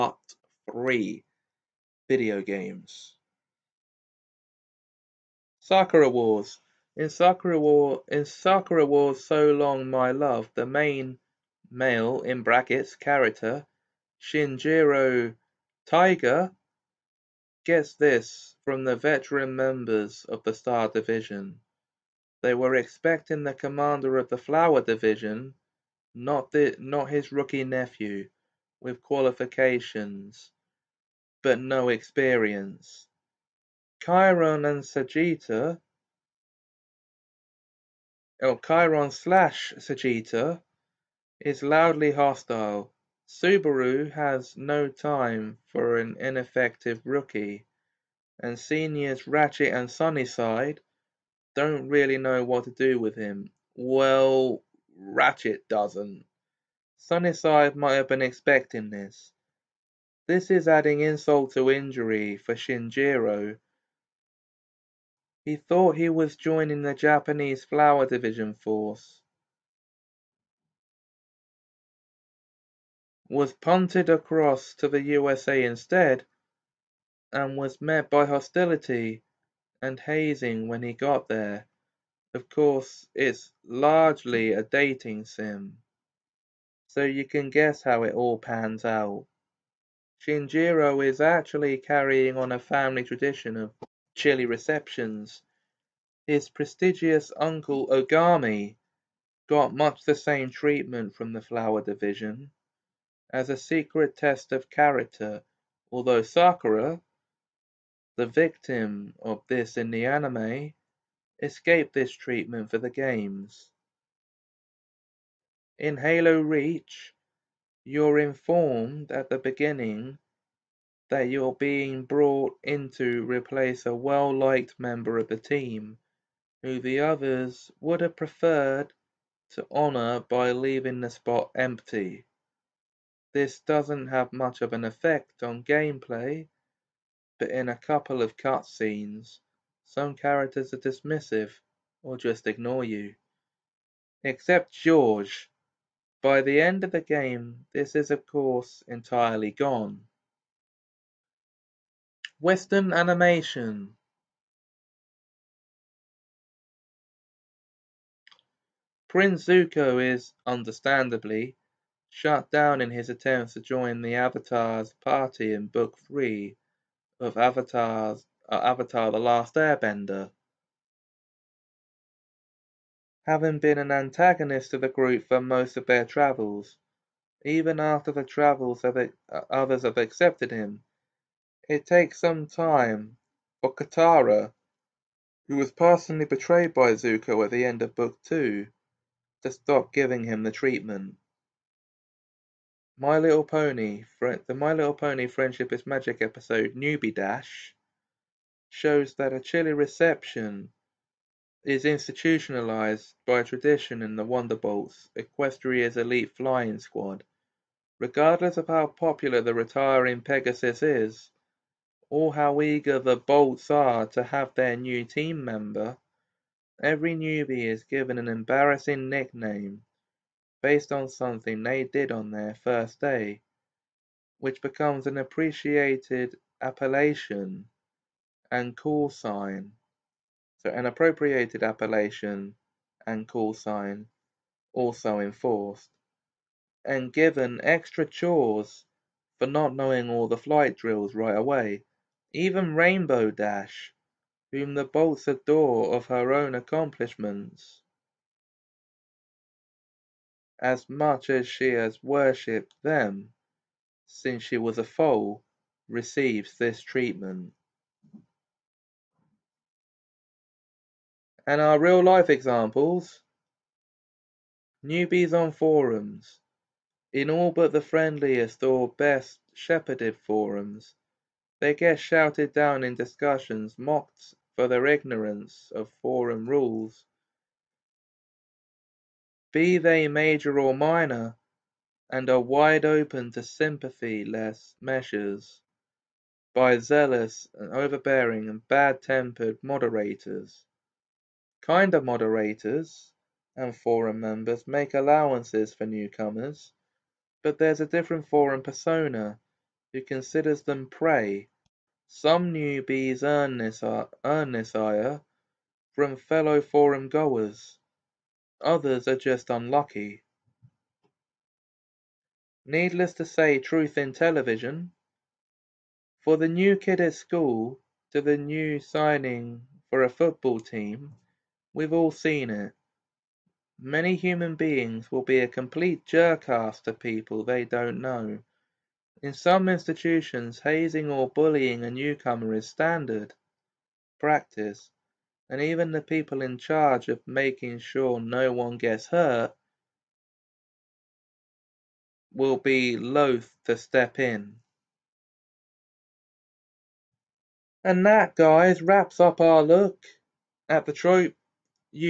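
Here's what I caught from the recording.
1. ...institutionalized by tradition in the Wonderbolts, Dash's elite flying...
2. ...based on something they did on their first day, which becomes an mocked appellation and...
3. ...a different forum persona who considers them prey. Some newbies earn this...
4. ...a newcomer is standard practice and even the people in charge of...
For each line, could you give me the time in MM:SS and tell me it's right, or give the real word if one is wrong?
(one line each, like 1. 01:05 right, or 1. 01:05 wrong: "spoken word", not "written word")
1. 03:21 wrong: "Equestria", not "Dash"
2. 03:40 wrong: "appreciated", not "mocked"
3. 04:57 right
4. 05:31 right.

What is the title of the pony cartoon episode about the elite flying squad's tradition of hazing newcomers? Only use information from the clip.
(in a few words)
Newbie Dash.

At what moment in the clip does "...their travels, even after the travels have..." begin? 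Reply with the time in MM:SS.
02:55.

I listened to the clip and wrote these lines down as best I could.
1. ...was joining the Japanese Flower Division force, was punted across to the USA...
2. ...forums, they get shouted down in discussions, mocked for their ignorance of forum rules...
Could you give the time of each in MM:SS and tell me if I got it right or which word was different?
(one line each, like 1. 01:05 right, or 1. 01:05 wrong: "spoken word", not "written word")
1. 01:06 right
2. 04:30 right.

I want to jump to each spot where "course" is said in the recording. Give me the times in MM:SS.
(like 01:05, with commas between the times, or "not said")
01:22, 02:28.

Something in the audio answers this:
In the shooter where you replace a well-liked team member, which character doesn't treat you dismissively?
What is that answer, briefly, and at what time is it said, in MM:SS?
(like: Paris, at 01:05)
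George, at 02:24.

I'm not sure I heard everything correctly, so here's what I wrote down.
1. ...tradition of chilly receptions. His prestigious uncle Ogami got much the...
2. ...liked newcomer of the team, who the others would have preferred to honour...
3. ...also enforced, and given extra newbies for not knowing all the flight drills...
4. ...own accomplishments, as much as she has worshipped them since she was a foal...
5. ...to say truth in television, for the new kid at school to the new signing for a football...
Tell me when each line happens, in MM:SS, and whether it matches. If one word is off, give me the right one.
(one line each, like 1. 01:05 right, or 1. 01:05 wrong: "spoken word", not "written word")
1. 01:33 right
2. 02:04 wrong: "member", not "newcomer"
3. 03:54 wrong: "chores", not "newbies"
4. 04:06 right
5. 05:13 right.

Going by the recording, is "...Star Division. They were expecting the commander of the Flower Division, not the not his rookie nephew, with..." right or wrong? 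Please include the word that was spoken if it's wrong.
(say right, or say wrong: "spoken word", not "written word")
right.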